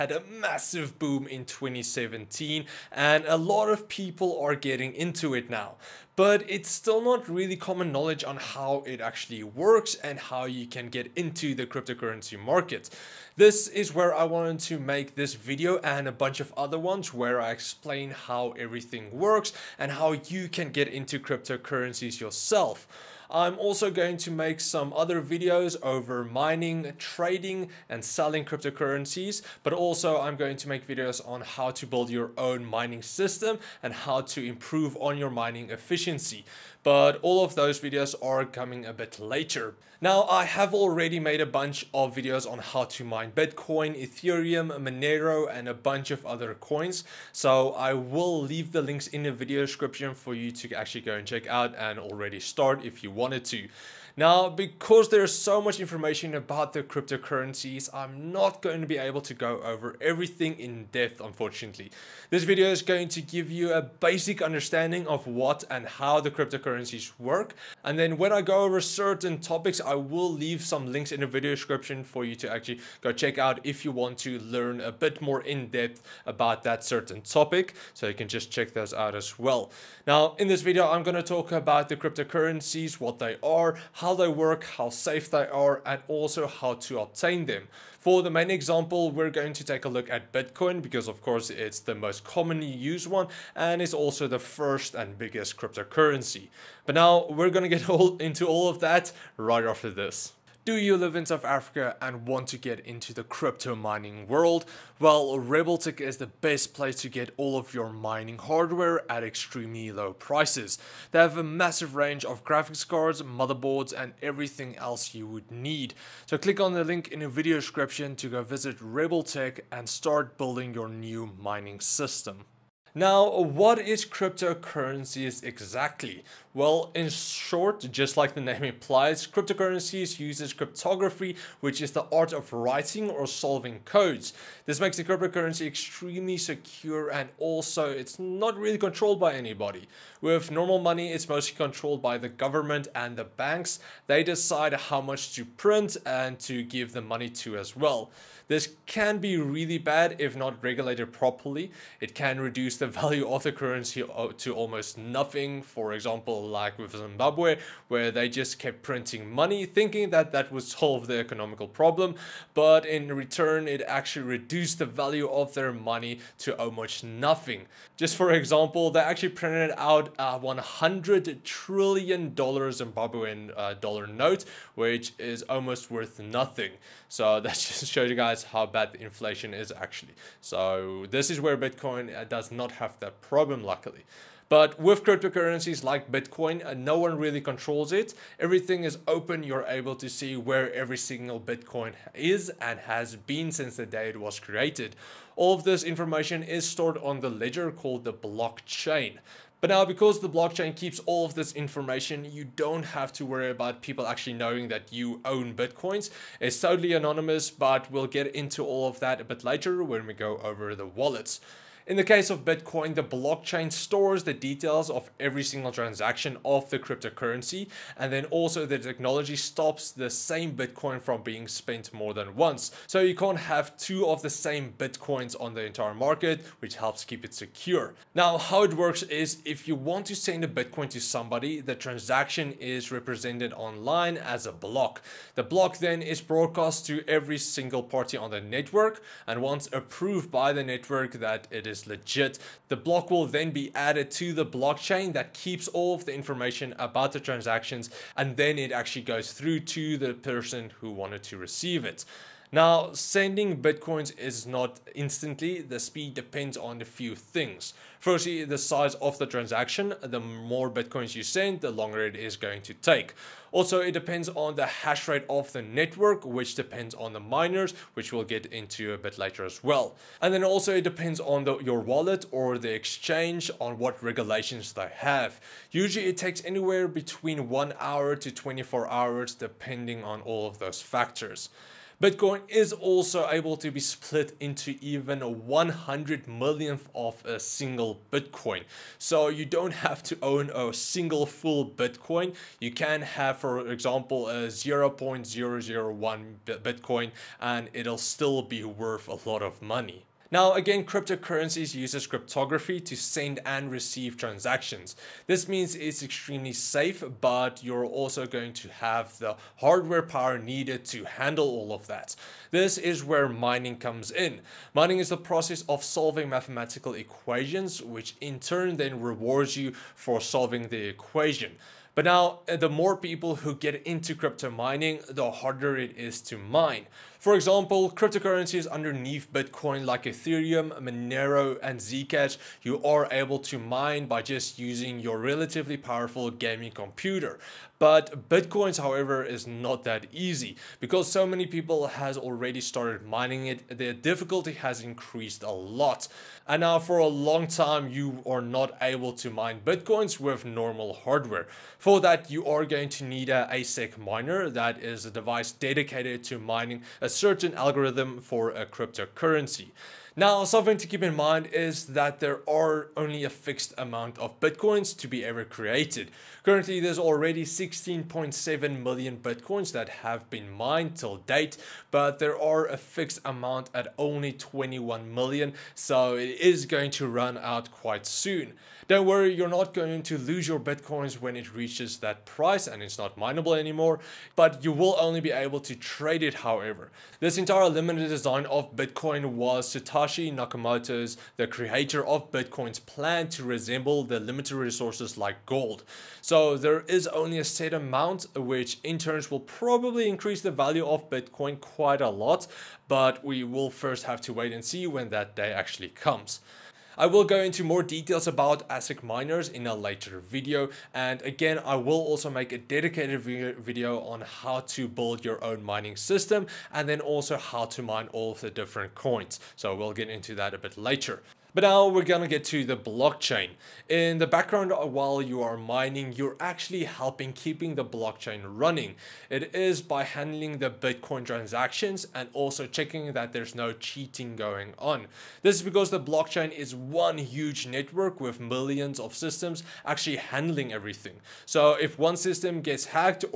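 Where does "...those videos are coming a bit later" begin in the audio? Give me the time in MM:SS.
00:37.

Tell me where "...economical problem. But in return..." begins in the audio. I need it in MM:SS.
02:41.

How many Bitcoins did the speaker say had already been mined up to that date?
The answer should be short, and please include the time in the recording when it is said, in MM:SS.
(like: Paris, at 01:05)
16.7 million, at 06:07.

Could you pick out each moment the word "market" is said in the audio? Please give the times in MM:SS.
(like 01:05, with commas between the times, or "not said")
00:12, 03:45.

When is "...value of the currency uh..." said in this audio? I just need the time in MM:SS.
02:32.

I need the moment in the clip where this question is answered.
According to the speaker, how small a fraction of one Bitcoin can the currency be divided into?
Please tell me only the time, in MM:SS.
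04:45.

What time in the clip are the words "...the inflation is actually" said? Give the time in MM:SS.
02:58.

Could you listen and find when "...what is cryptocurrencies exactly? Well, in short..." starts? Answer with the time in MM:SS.
02:03.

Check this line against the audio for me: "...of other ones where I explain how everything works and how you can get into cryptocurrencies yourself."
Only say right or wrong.
right.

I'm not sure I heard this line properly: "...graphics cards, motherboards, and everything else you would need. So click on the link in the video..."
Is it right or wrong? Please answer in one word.
right.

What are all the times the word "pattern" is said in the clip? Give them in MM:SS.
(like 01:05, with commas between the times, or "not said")
not said.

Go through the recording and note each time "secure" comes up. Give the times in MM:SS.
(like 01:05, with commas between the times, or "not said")
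02:16, 03:47.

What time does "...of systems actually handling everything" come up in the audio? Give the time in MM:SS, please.
07:18.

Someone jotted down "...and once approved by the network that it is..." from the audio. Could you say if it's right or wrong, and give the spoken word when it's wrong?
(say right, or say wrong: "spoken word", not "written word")
right.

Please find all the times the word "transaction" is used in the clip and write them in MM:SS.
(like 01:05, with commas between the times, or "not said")
03:35, 03:51, 04:07, 04:19, 05:04, 07:11.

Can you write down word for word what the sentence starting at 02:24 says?
They decide how much to print and to give the money to as well.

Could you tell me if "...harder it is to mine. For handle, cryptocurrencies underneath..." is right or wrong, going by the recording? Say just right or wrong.
wrong.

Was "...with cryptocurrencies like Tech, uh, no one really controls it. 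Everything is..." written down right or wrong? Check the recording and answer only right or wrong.
wrong.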